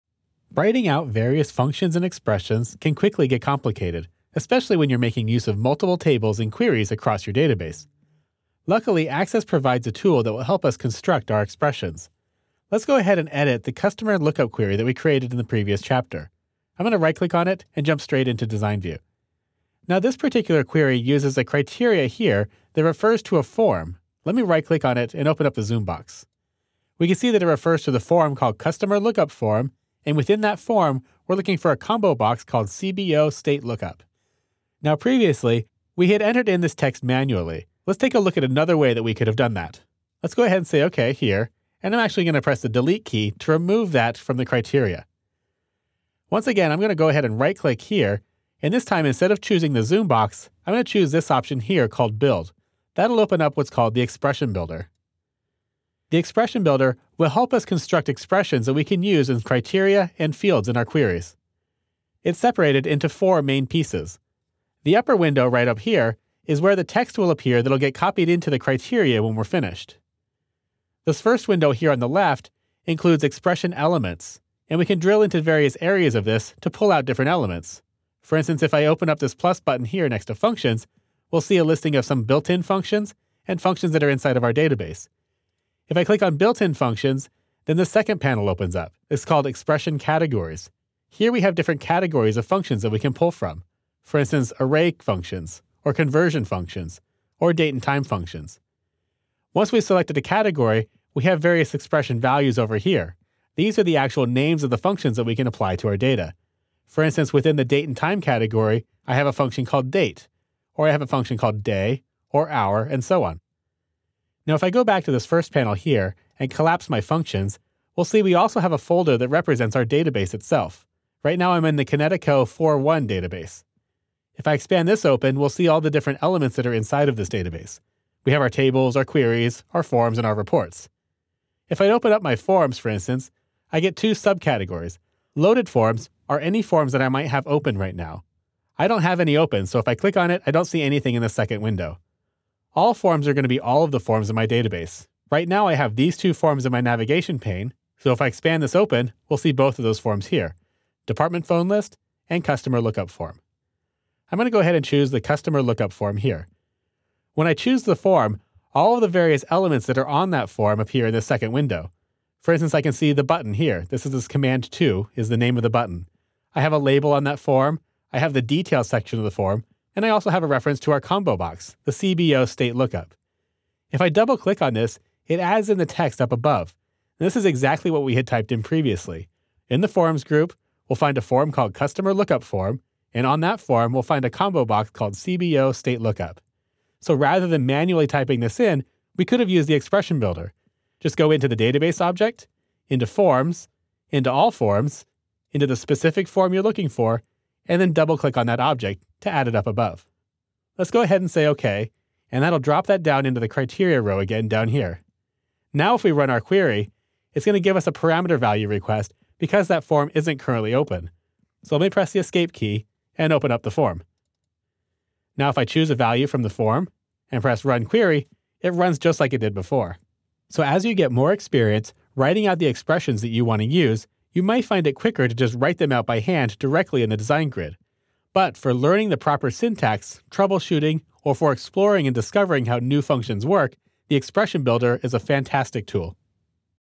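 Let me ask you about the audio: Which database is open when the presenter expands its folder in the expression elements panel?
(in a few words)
Kinetico 41.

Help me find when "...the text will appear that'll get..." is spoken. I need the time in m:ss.
1:06.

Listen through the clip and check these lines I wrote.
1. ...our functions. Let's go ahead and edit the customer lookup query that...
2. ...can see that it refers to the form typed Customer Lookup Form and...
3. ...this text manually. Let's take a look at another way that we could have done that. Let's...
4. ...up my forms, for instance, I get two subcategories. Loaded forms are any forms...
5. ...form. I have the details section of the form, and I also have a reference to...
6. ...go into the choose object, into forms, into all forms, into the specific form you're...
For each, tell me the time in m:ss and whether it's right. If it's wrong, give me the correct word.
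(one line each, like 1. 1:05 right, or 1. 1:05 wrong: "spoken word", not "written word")
1. 0:11 wrong: "expressions", not "functions"
2. 0:27 wrong: "called", not "typed"
3. 0:36 right
4. 2:12 right
5. 2:47 right
6. 3:11 wrong: "database", not "choose".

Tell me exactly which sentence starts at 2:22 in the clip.
All forms are going to be all of the forms in my database.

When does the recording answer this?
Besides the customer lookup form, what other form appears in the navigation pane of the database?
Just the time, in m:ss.
2:31.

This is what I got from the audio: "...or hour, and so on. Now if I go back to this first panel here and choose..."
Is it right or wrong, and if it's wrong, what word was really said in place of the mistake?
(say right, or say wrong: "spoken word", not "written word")
wrong: "collapse", not "choose".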